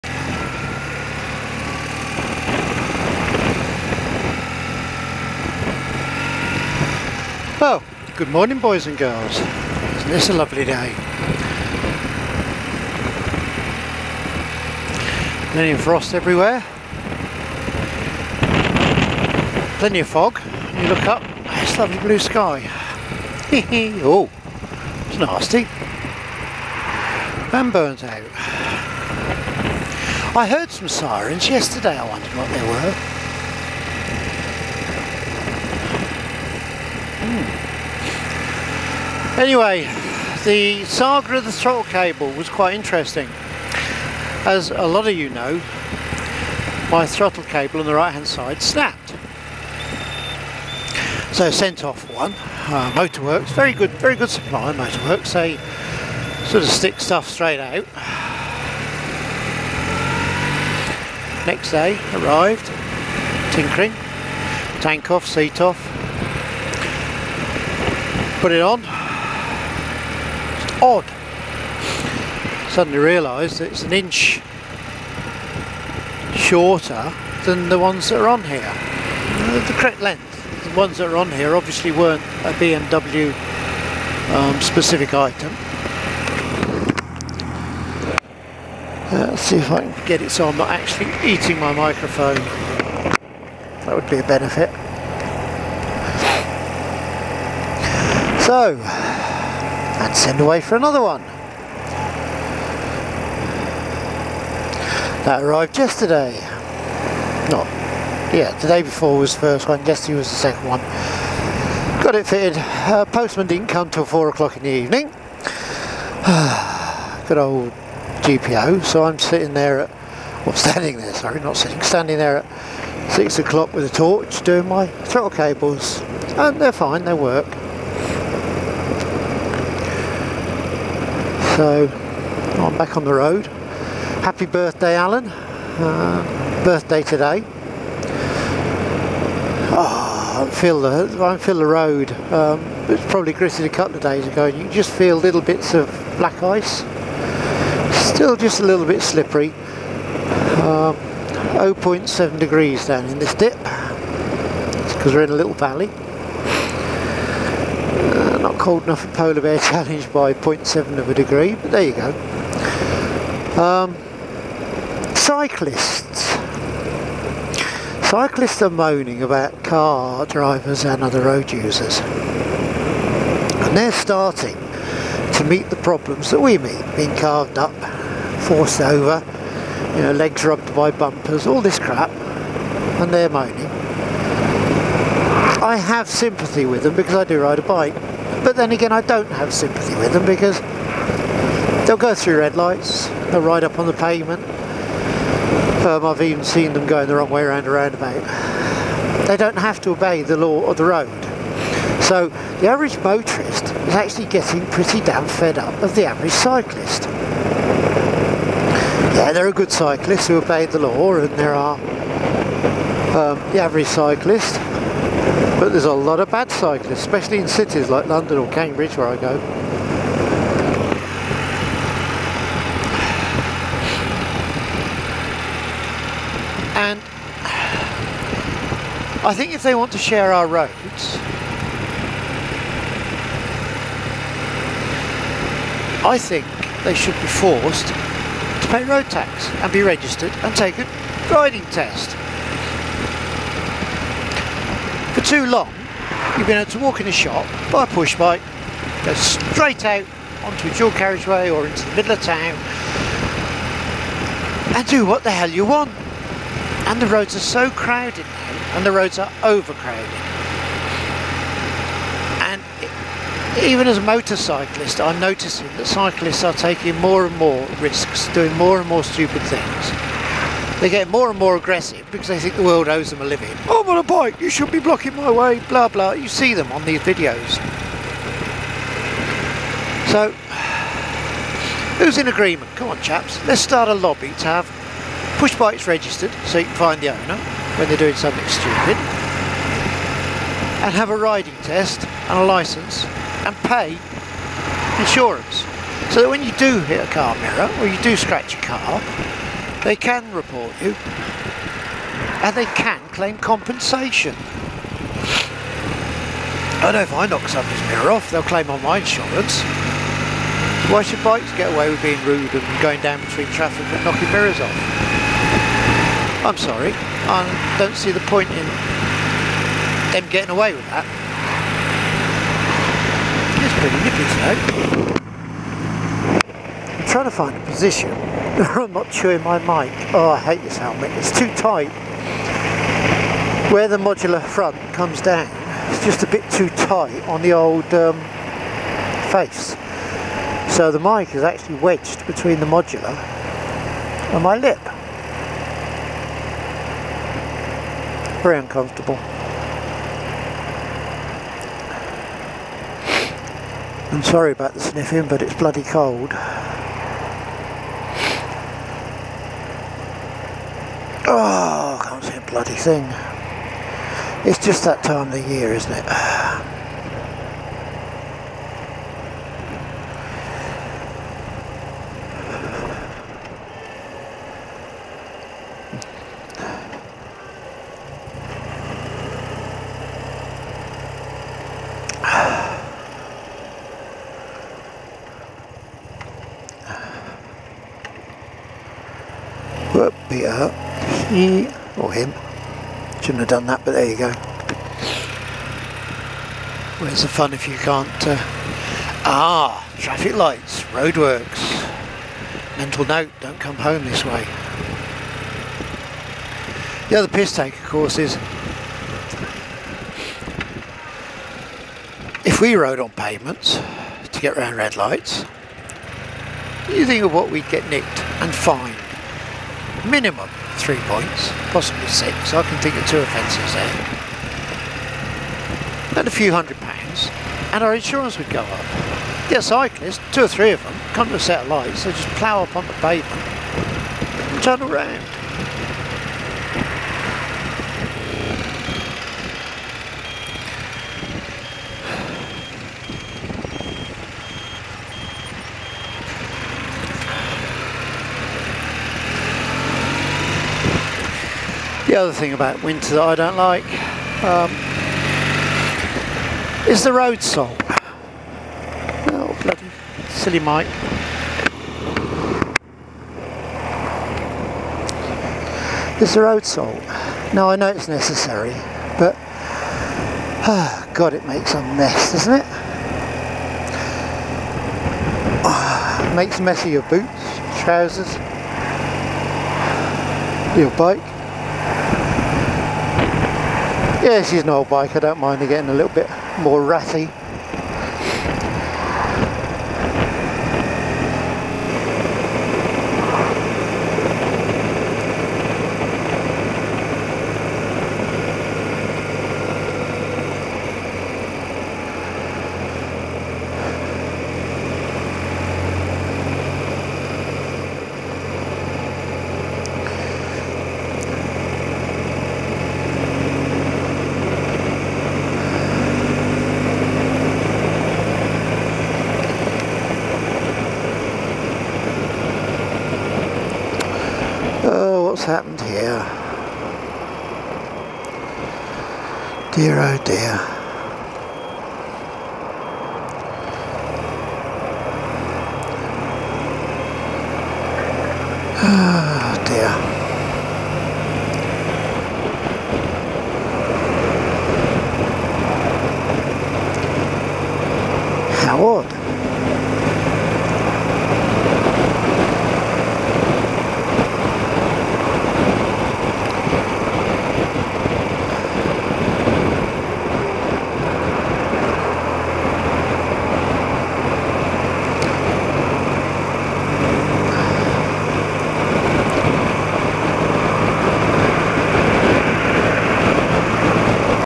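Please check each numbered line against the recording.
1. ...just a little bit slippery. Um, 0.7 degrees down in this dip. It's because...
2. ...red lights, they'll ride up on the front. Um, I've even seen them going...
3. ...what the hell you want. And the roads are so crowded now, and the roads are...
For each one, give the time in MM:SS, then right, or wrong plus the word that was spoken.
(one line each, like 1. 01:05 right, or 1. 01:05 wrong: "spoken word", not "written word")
1. 02:28 right
2. 03:12 wrong: "pavement", not "front"
3. 04:15 right.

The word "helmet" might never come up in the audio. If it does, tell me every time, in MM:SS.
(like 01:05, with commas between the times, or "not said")
05:30.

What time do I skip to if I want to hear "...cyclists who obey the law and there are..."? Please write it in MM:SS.
03:29.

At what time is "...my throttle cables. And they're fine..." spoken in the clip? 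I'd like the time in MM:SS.
02:04.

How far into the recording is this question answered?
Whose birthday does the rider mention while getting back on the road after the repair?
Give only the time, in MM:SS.
02:14.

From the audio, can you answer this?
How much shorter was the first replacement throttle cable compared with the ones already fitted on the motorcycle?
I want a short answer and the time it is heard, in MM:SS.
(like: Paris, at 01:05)
an inch, at 01:13.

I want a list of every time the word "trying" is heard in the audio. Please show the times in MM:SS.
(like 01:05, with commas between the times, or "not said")
05:27.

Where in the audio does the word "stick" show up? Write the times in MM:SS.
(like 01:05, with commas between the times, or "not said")
00:56.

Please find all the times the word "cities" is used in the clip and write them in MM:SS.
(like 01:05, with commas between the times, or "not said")
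03:37.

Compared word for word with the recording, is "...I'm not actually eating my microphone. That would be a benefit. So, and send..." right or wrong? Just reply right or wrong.
right.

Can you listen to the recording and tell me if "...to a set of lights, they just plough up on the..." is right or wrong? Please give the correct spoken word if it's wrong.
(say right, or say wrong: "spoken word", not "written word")
right.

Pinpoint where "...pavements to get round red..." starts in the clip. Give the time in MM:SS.
06:53.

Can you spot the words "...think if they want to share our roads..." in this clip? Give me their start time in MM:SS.
03:49.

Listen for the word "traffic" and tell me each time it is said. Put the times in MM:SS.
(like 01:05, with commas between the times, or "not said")
05:13, 06:39.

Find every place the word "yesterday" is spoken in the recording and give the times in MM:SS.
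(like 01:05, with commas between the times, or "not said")
00:31, 01:45, 01:49.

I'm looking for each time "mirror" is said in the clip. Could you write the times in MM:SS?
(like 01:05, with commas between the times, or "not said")
04:57, 05:07, 05:14.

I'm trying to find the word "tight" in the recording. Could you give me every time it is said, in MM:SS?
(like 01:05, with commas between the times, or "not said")
05:31, 05:36.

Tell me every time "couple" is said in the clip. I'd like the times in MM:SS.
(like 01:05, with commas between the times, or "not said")
02:23.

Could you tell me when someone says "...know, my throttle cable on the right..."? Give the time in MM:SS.
00:45.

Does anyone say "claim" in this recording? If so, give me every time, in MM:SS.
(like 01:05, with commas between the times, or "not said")
05:03, 05:08.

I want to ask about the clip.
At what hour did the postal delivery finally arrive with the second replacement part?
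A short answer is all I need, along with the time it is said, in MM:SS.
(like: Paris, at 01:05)
4 o'clock, at 01:54.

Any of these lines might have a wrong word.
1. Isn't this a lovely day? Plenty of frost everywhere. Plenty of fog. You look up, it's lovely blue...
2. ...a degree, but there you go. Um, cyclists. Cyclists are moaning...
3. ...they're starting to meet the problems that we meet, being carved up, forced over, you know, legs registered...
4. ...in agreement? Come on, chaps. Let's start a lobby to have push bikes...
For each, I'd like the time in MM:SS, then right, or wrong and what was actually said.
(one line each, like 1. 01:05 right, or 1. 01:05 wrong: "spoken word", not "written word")
1. 00:09 right
2. 02:41 right
3. 02:53 wrong: "rubbed", not "registered"
4. 04:42 right.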